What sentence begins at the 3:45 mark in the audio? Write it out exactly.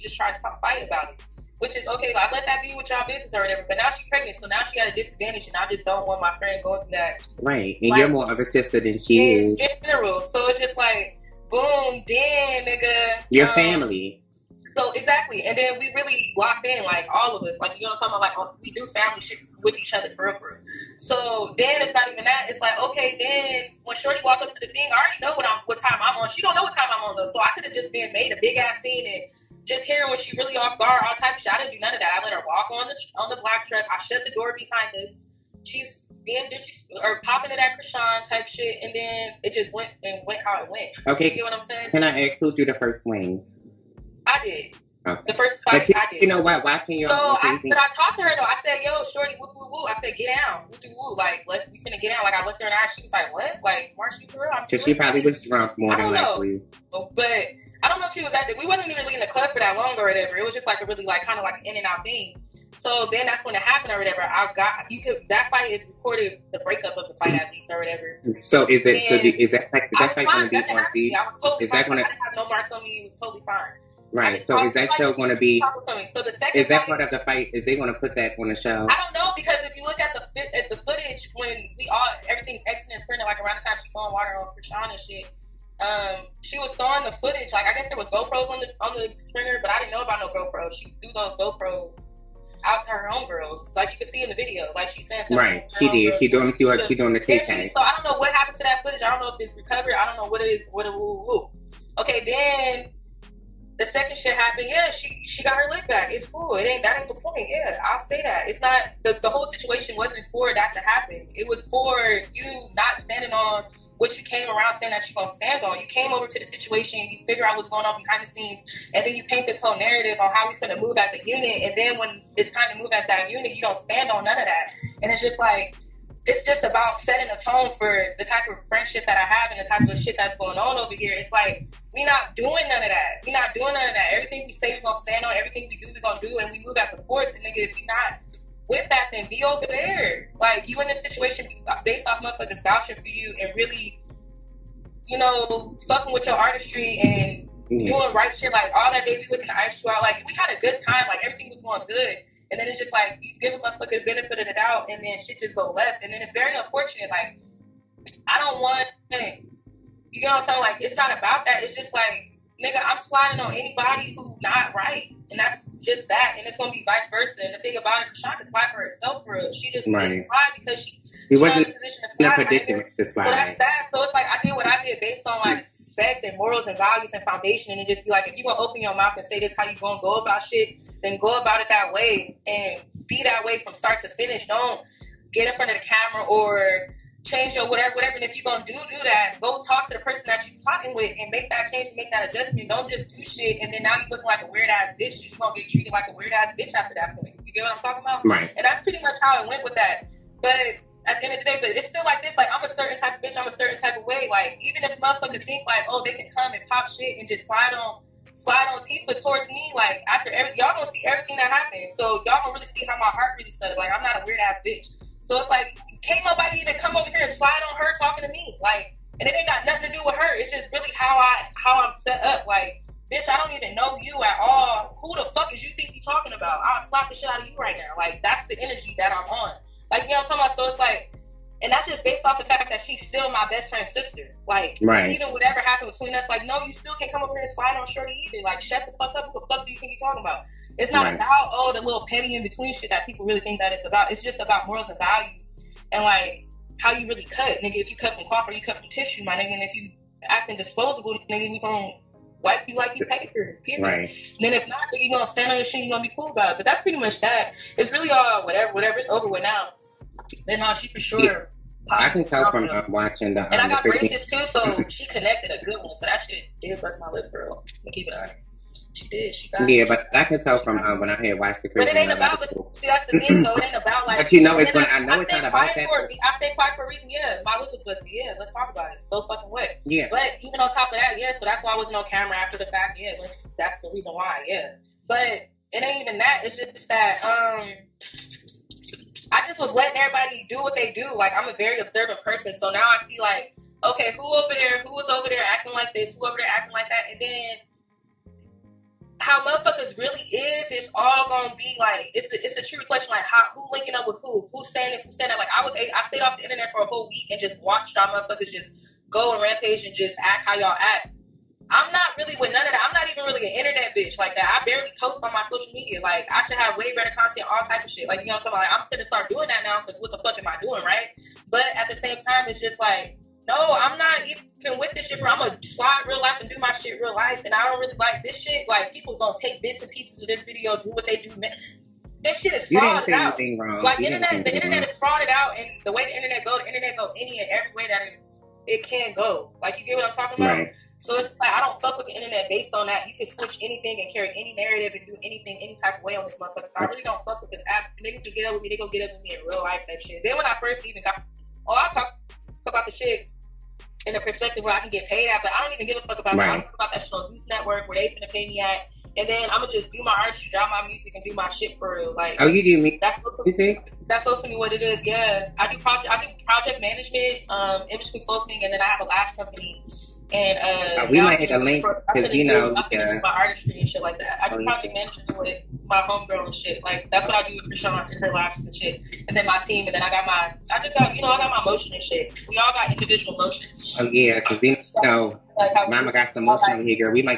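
Who the fuck is you think you talking about?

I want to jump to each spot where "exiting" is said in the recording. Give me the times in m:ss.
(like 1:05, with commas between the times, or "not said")
1:22.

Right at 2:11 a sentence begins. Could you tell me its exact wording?
It's like we not doing none of that.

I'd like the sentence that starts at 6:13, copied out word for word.
my artistry and shit like that.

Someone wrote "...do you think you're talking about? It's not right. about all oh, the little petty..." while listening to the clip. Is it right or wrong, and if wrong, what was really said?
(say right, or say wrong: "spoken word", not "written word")
right.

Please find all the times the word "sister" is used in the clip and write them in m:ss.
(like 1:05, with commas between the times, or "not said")
0:08, 3:53.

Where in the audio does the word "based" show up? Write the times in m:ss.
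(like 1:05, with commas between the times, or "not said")
2:21, 2:54, 3:52, 5:42.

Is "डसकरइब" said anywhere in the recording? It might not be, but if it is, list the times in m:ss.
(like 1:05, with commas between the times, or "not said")
not said.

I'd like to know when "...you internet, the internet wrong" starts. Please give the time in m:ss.
5:33.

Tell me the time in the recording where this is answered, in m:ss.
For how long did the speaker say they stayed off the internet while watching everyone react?
5:06.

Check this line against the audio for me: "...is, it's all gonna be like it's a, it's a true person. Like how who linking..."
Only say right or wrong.
wrong.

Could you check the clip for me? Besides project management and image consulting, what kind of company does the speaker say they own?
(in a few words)
lash company.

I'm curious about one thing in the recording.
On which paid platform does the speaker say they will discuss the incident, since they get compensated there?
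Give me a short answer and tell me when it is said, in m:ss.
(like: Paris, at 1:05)
Zeus Network, at 5:57.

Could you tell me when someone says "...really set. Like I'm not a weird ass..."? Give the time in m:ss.
3:33.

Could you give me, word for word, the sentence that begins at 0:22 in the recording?
It's like okay, then when Shorty walk up to the thing, I already know what I'm, what time I'm on.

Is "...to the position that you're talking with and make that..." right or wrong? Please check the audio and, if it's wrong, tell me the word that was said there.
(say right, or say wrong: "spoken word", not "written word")
wrong: "person", not "position".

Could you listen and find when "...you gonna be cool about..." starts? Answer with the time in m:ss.
4:15.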